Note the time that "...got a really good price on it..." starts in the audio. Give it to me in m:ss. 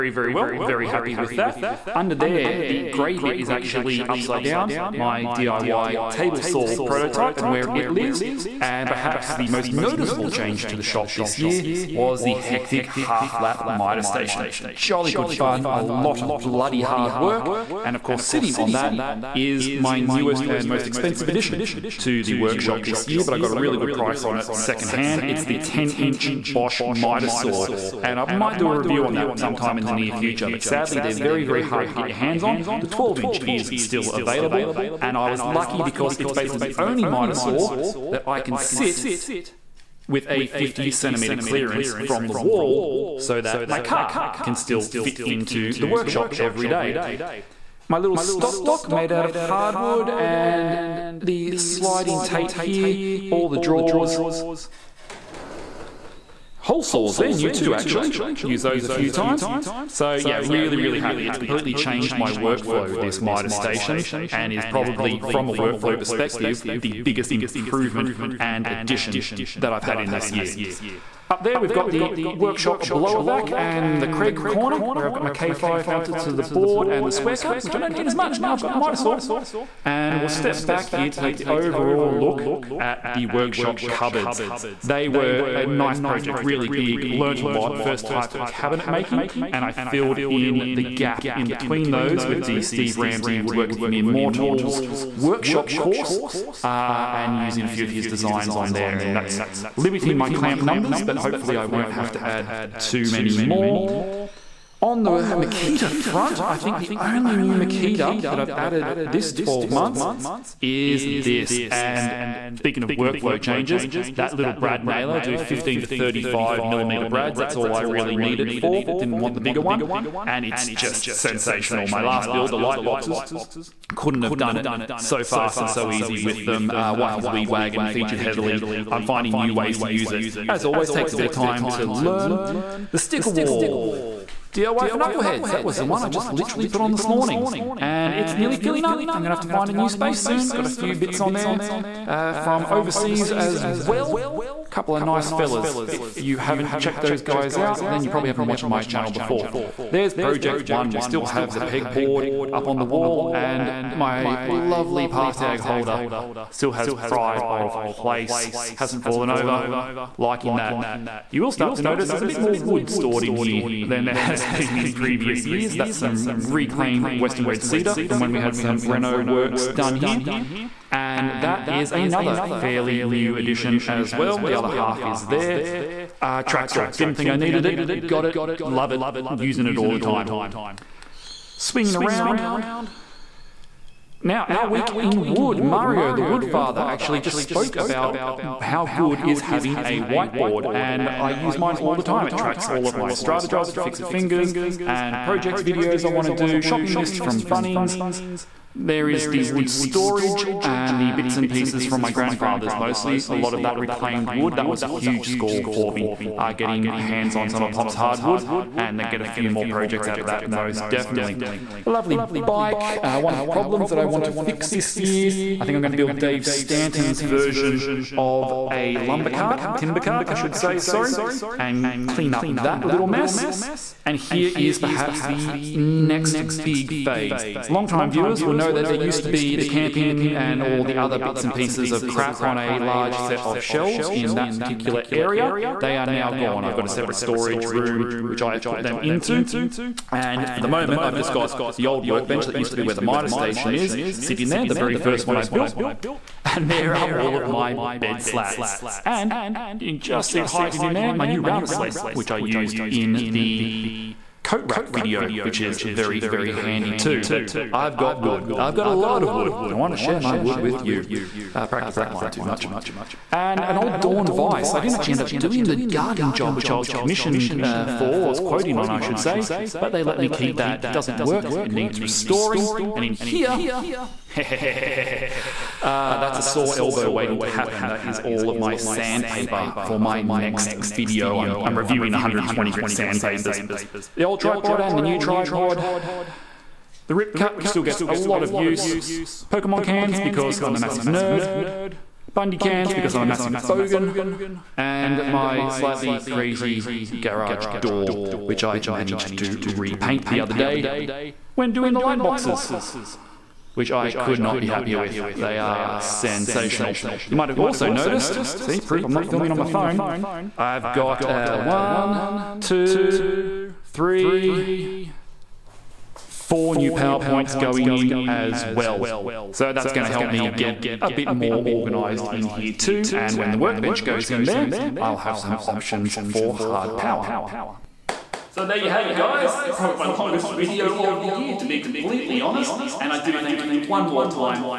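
0:23.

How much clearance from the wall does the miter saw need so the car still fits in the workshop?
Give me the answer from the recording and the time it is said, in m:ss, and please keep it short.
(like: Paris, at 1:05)
50 centimeters, at 0:40.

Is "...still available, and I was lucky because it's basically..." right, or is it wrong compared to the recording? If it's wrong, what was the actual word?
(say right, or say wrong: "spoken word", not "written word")
right.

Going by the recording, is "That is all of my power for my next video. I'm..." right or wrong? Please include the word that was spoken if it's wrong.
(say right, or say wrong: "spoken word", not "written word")
wrong: "sandpaper", not "power".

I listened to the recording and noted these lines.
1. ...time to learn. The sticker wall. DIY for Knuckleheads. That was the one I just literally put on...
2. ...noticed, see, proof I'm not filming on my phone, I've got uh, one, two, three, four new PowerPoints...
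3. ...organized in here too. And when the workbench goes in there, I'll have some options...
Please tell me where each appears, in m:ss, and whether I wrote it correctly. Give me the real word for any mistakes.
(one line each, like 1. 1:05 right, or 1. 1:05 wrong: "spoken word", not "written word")
1. 2:11 right
2. 5:07 right
3. 5:21 right.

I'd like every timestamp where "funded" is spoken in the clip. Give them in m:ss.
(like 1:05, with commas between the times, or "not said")
not said.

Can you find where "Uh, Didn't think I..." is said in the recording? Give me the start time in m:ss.
2:56.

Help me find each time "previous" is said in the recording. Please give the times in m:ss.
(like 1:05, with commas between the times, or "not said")
2:44.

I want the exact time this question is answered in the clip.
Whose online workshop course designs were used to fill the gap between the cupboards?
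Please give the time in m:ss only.
1:32.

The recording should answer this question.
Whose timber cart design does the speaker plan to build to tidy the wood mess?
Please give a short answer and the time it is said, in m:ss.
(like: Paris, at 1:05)
Dave Stanton, at 3:36.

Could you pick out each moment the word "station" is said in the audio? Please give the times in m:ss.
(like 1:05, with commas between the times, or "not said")
0:14, 1:03, 4:03.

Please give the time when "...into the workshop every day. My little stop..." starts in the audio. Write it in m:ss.
0:45.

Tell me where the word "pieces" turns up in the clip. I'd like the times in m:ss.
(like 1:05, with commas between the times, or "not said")
3:21, 3:51.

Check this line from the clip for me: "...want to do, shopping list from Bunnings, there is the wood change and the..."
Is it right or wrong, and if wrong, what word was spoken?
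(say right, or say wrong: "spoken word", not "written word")
wrong: "storage", not "change".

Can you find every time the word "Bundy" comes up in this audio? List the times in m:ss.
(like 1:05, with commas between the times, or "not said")
4:52.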